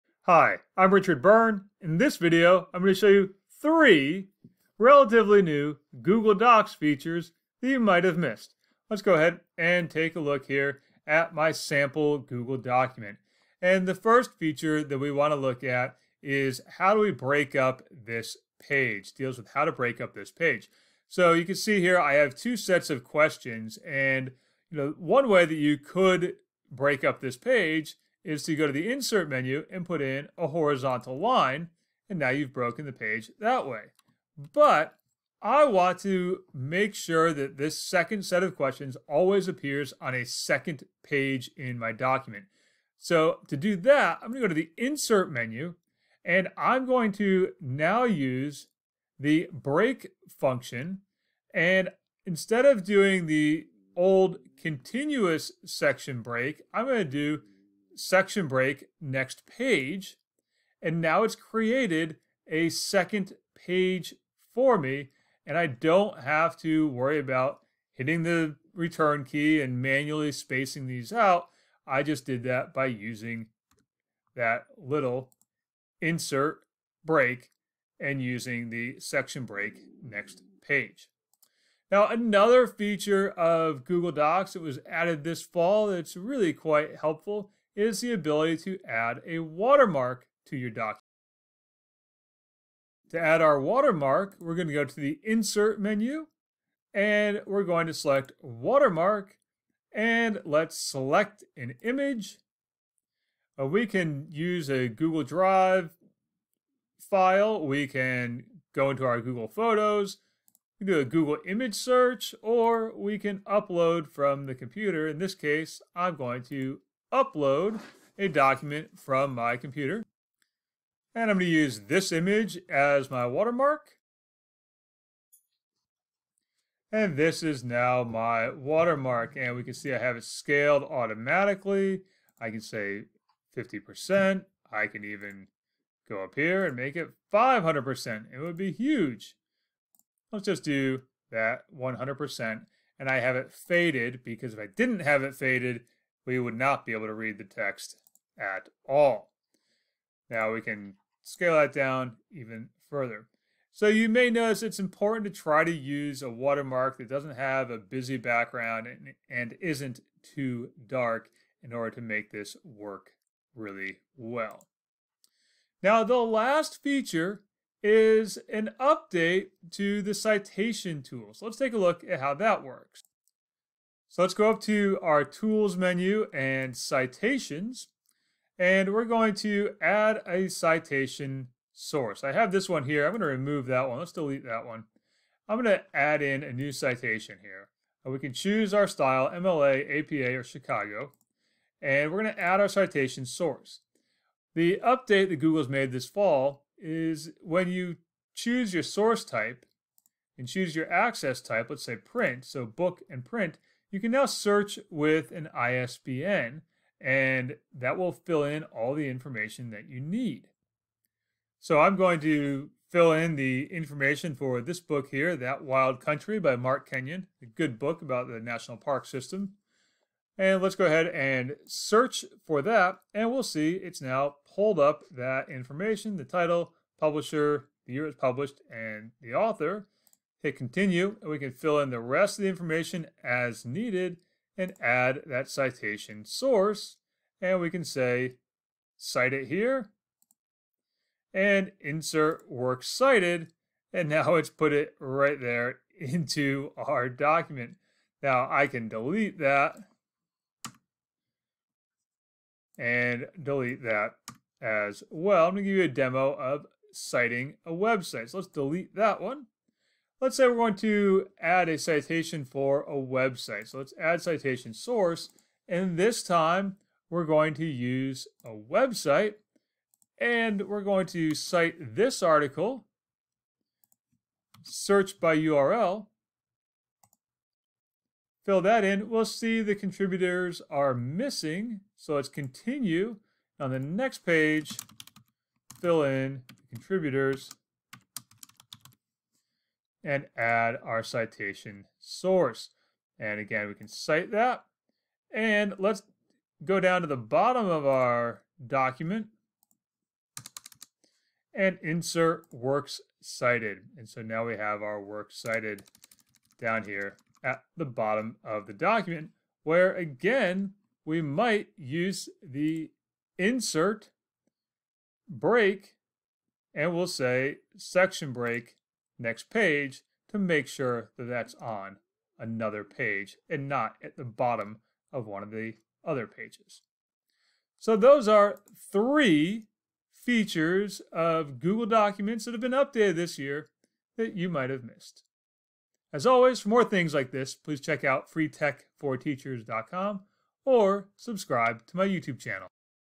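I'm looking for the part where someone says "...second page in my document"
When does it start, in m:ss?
0:40.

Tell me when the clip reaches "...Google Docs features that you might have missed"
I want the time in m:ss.
0:06.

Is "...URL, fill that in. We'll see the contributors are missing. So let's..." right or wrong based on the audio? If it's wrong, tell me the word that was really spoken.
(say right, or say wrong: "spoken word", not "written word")
right.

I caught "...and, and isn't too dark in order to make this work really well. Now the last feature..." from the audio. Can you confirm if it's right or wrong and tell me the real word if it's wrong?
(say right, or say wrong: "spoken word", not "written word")
right.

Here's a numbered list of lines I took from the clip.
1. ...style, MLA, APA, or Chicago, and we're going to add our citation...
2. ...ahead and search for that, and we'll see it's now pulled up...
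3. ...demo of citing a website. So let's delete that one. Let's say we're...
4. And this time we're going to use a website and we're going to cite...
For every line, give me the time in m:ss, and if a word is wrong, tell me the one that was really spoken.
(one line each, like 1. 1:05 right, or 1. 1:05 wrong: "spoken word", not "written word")
1. 3:08 right
2. 3:40 right
3. 4:15 right
4. 4:25 right.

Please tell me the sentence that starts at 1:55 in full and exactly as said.
In this case, I'm going to upload a document from my computer.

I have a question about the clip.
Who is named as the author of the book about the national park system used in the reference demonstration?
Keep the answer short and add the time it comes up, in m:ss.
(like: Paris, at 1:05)
Mark Kenyon, at 3:36.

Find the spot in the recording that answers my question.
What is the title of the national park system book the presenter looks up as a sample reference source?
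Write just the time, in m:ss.
3:35.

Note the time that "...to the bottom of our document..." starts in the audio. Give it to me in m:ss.
4:57.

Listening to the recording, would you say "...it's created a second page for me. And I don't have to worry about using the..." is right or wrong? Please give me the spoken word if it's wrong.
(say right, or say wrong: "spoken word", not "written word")
wrong: "hitting", not "using".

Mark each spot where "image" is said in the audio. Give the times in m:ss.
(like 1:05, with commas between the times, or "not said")
1:41, 1:51, 2:02.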